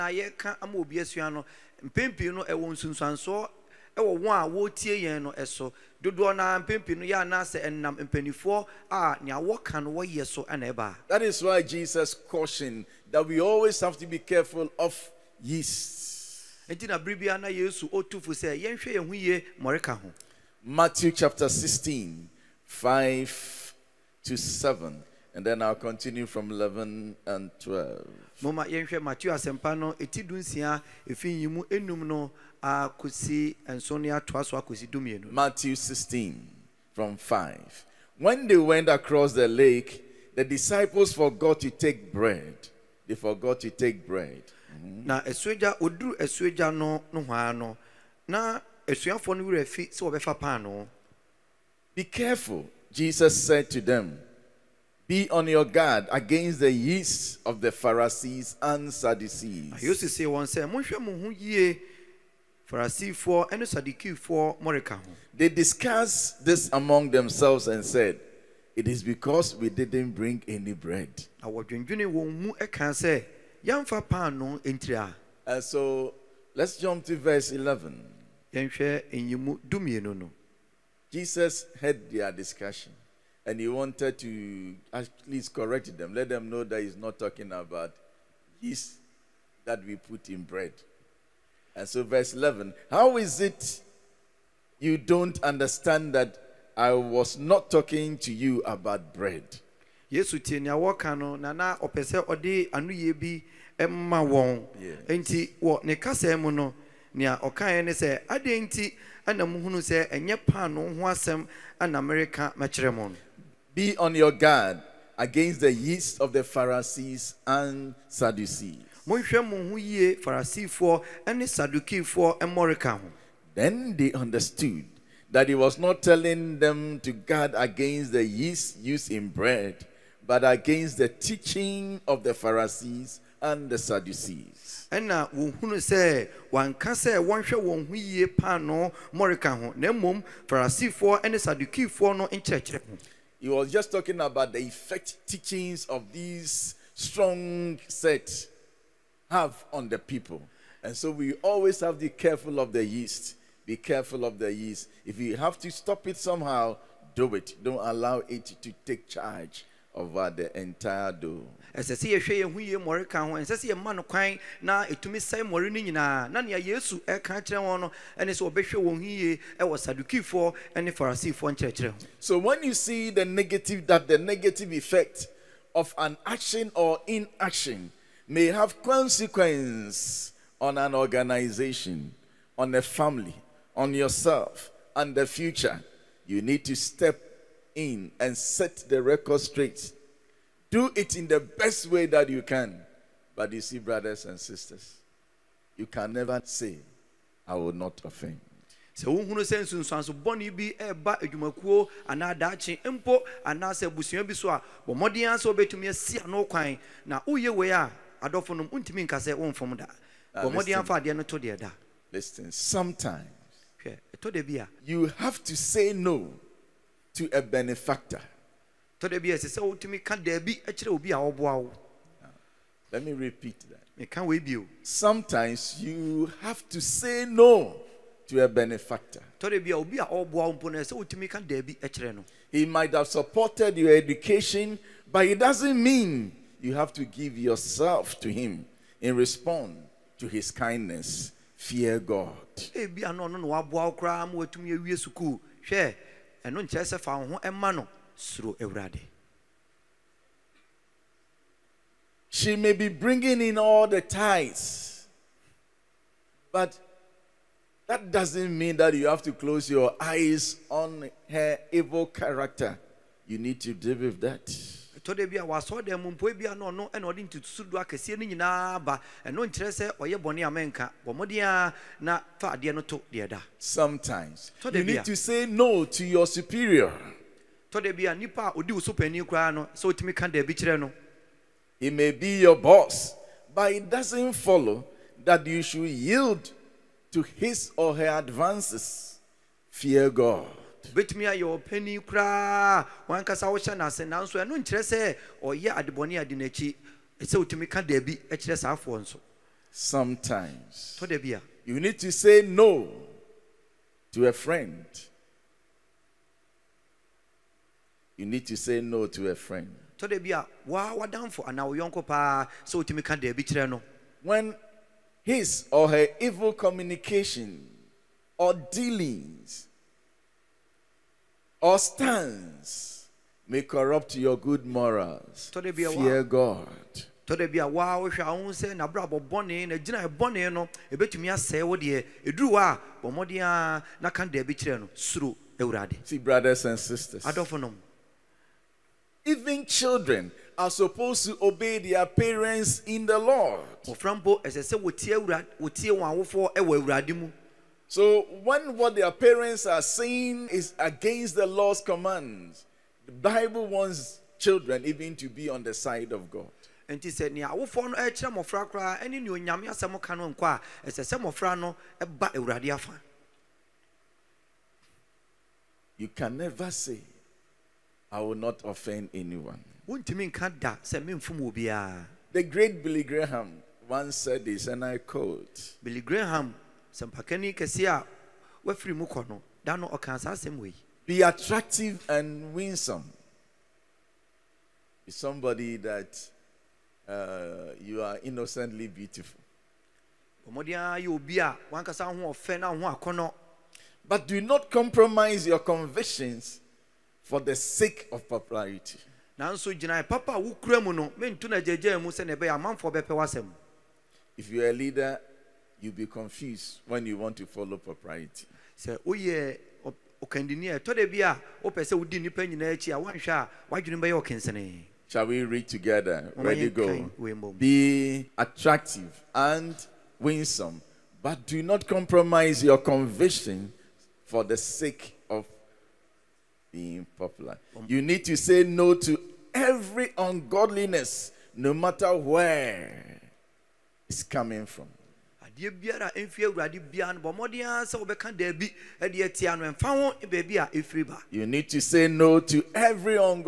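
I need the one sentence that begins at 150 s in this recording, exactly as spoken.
And so we always have to be careful of the yeast.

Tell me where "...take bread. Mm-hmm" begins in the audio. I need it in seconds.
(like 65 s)
43 s.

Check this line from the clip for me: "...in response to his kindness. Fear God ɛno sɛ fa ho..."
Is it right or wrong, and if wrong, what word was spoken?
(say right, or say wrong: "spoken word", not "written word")
right.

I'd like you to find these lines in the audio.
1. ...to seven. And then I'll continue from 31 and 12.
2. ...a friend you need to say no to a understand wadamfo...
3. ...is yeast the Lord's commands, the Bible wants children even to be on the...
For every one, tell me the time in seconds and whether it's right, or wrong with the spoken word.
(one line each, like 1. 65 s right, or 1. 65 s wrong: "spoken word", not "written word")
1. 24 s wrong: "11", not "31"
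2. 304 s wrong: "friend", not "understand"
3. 350 s wrong: "against", not "yeast".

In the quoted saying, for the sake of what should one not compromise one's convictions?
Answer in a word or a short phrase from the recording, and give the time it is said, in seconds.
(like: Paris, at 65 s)
popularity, at 398 s.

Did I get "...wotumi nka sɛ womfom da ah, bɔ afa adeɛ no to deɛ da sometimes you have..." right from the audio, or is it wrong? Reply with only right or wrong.
wrong.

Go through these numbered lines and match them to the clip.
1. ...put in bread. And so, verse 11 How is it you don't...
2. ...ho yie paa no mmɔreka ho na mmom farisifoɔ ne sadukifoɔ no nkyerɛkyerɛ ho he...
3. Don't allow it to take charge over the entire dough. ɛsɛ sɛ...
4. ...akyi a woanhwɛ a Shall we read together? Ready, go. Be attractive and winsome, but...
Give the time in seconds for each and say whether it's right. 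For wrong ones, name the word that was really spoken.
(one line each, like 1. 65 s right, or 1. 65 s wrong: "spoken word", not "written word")
1. 89 s right
2. 137 s right
3. 157 s right
4. 412 s right.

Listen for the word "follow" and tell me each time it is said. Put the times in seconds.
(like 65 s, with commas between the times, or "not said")
284 s, 407 s.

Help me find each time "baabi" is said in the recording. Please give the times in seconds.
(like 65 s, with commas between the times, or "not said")
440 s.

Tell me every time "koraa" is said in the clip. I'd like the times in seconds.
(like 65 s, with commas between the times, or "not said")
278 s, 292 s.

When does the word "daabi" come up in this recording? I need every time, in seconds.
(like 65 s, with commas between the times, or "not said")
297 s, 313 s, 438 s.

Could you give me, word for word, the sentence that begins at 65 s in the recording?
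They discussed this among themselves and said, It is because we didn't bring any bread.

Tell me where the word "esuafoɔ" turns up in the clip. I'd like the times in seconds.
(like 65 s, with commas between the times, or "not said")
48 s.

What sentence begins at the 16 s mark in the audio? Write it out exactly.
nti na biribi ana yesu otu fo sɛ yɛnhwɛ yɛn ho yie ho.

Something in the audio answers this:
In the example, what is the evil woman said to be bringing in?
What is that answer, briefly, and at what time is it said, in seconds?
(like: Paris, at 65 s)
all the tithes, at 253 s.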